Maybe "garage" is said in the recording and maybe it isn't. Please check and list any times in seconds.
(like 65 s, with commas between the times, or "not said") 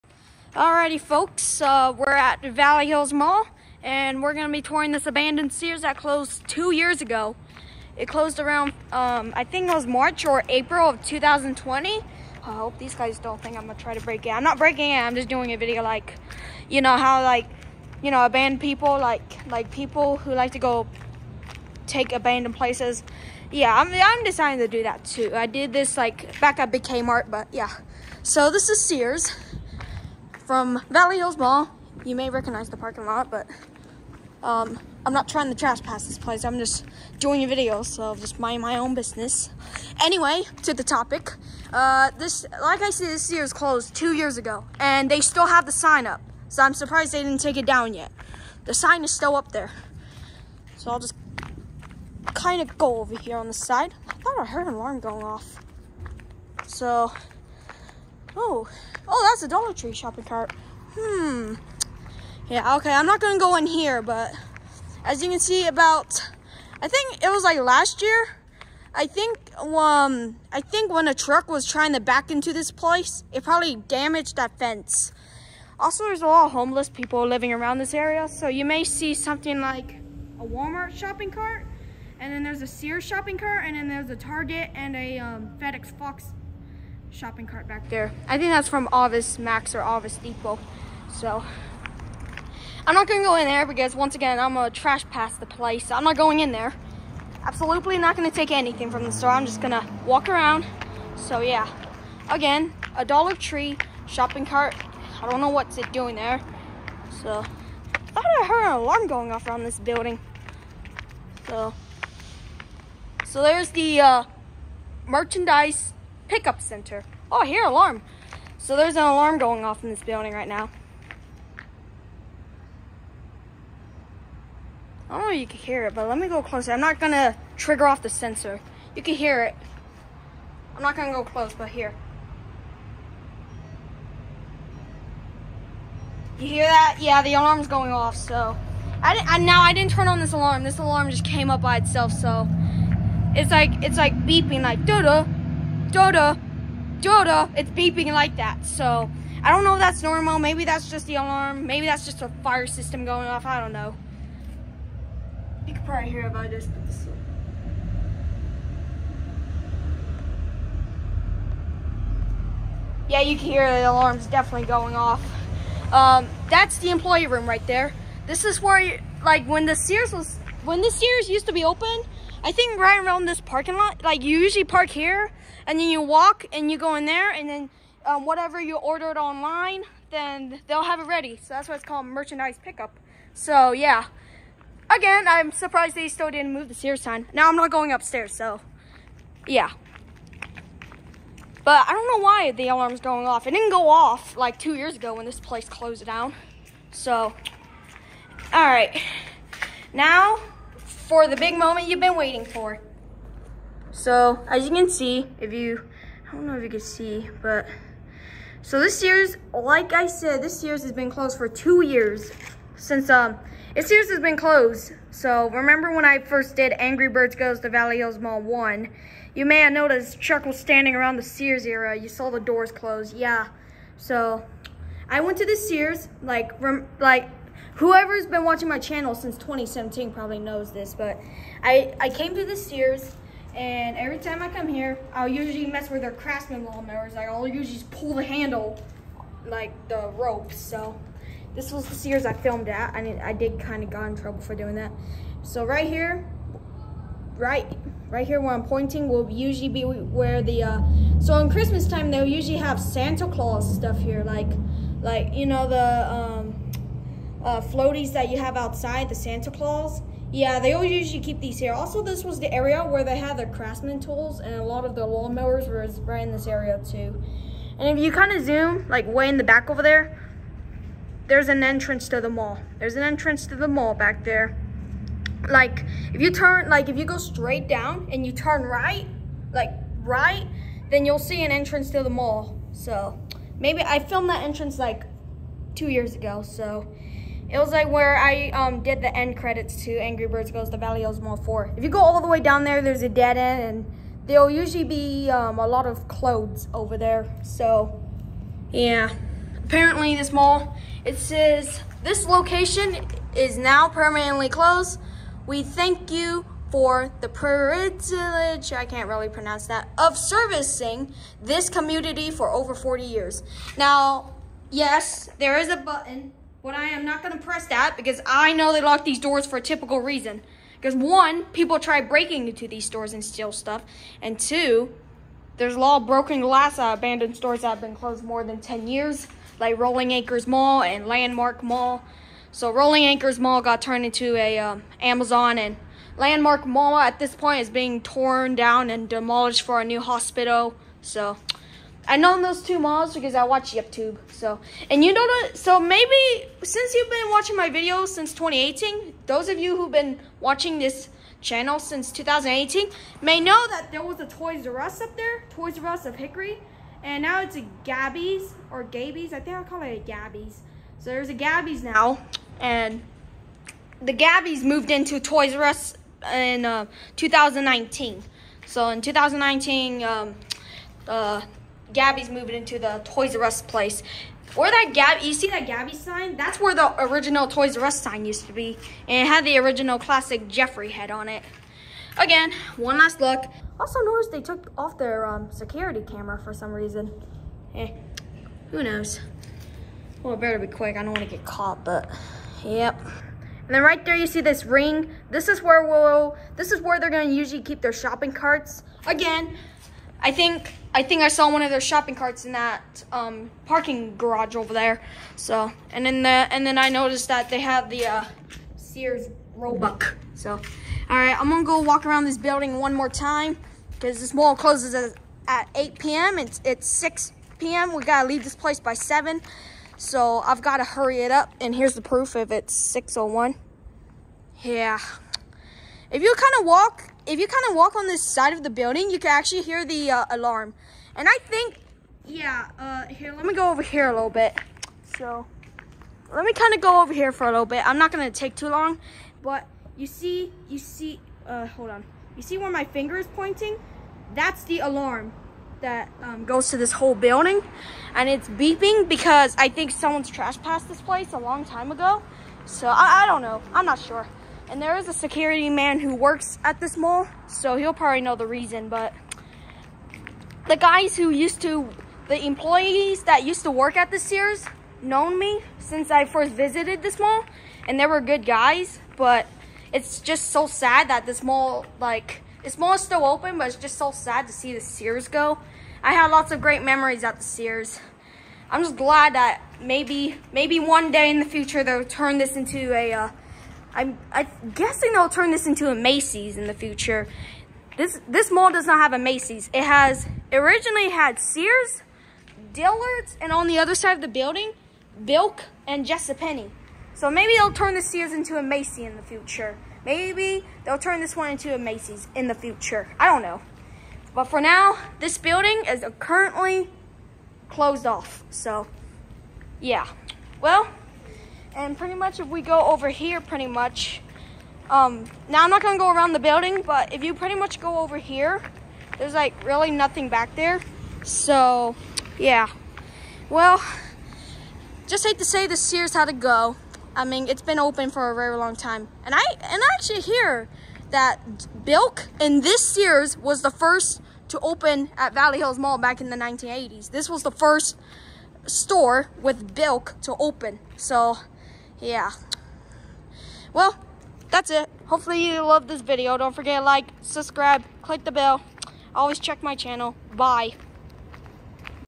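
404 s.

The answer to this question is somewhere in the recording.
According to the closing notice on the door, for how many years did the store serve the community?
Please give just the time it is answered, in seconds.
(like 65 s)
312 s.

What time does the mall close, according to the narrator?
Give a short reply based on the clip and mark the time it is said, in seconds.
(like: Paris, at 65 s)
8 p.m., at 415 s.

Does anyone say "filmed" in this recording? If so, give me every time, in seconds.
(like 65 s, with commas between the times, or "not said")
242 s, 283 s.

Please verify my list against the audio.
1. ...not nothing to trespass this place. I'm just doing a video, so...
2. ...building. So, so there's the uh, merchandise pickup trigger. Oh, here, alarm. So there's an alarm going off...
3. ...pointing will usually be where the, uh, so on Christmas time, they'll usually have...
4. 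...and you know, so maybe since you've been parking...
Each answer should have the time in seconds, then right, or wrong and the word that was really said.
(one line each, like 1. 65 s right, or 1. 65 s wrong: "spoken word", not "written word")
1. 35 s wrong: "trying", not "nothing"
2. 109 s wrong: "center", not "trigger"
3. 248 s right
4. 344 s wrong: "watching", not "parking".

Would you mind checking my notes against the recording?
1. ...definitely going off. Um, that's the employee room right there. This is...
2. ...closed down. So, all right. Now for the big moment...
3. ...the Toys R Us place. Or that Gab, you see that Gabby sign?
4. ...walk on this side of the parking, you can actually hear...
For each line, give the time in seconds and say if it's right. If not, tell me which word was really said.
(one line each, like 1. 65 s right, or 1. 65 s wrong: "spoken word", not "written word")
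1. 164 s right
2. 195 s right
3. 372 s right
4. 427 s wrong: "building", not "parking".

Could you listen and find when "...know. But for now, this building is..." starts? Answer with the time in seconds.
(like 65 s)
503 s.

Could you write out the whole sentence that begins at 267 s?
And if you kind of zoom, like way in the back over there, there's an entrance to the mall.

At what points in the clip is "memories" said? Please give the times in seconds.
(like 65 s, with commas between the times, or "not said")
476 s.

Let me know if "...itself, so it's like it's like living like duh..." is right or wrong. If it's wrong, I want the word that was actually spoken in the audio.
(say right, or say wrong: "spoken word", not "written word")
wrong: "beeping", not "living".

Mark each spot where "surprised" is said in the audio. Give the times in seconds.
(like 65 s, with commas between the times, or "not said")
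46 s, 185 s.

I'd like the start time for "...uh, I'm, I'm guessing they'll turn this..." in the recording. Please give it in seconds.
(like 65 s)
483 s.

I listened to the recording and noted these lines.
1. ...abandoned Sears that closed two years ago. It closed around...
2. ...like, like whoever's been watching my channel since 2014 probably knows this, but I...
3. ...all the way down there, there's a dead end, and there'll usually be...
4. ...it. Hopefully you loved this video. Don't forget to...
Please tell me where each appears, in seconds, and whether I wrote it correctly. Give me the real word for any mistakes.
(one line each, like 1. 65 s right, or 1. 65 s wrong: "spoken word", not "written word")
1. 5 s right
2. 226 s wrong: "2017", not "2014"
3. 291 s right
4. 544 s right.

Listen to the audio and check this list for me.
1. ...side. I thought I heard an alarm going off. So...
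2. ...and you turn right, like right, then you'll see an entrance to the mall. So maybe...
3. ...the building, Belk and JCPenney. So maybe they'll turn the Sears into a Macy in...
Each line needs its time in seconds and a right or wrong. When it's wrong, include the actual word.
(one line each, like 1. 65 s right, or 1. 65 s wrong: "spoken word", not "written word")
1. 53 s right
2. 278 s right
3. 494 s right.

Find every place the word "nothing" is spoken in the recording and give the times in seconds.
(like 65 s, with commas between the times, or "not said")
519 s.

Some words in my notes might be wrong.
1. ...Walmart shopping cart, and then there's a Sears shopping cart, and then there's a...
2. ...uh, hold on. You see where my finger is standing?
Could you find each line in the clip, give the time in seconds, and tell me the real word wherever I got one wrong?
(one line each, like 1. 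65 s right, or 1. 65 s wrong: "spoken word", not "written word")
1. 80 s right
2. 441 s wrong: "pointing", not "standing".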